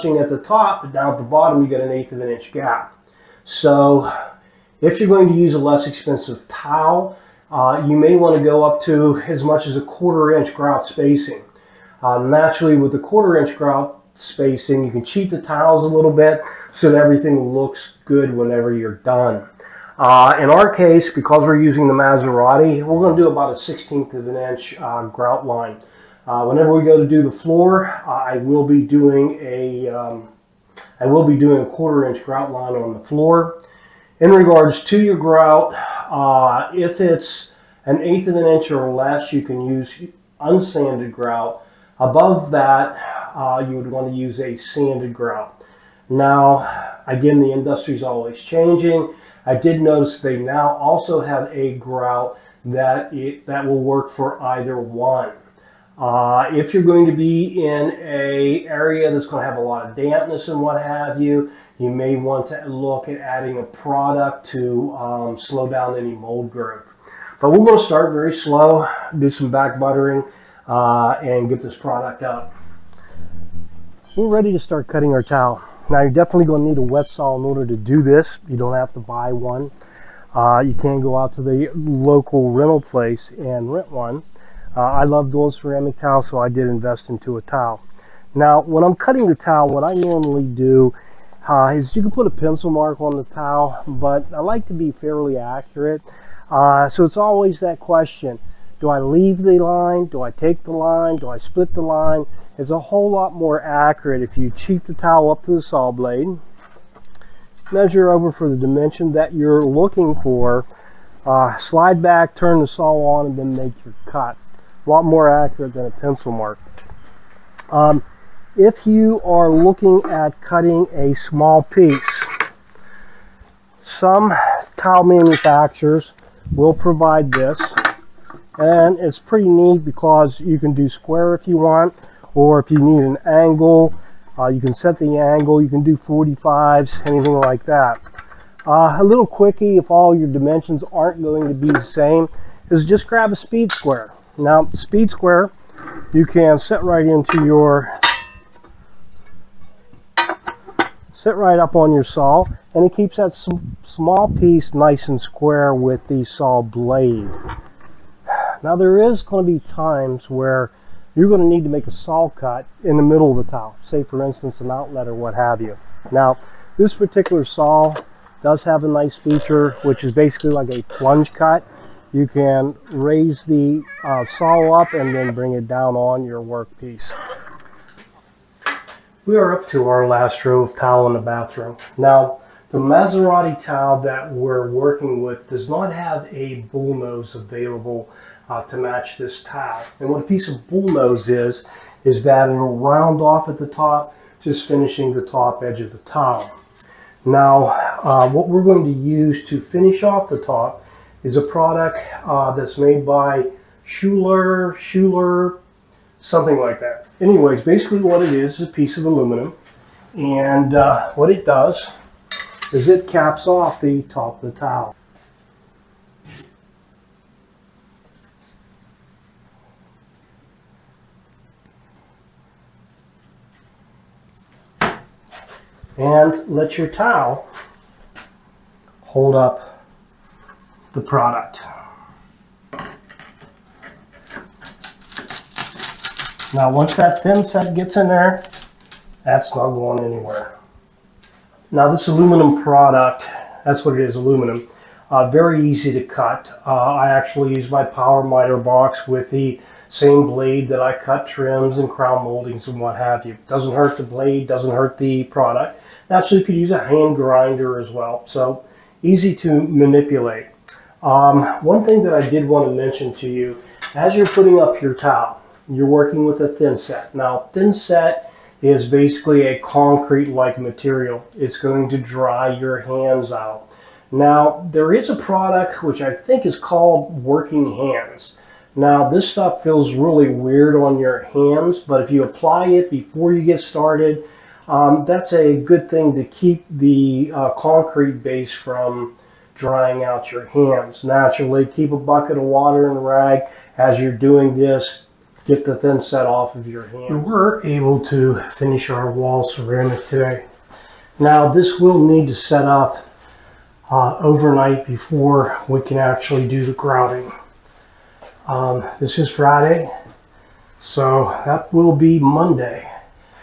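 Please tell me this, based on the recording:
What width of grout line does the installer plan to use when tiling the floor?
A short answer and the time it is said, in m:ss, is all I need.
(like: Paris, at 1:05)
1/4 inch, at 0:31.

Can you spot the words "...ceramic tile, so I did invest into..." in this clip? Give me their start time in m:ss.
1:25.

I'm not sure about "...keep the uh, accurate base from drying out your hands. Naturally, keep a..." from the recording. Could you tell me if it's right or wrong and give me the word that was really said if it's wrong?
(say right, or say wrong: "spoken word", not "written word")
wrong: "concrete", not "accurate".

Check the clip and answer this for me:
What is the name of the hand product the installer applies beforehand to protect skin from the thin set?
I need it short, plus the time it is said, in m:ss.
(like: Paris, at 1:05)
Working Hands, at 4:37.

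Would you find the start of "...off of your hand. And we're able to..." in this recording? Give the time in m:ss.
4:56.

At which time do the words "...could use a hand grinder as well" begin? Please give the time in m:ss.
4:16.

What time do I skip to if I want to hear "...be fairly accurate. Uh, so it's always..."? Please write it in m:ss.
1:34.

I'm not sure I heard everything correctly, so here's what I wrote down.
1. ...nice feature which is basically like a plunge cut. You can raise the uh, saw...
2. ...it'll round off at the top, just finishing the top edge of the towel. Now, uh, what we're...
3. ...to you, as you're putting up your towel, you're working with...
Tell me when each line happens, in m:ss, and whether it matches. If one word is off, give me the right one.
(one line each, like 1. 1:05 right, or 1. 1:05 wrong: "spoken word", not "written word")
1. 2:48 right
2. 3:12 right
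3. 4:23 right.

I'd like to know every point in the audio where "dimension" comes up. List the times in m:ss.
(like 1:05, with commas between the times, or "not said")
1:48, 2:20.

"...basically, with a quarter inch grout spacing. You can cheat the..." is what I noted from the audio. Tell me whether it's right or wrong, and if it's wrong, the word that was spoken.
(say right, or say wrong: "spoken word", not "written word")
wrong: "naturally", not "basically".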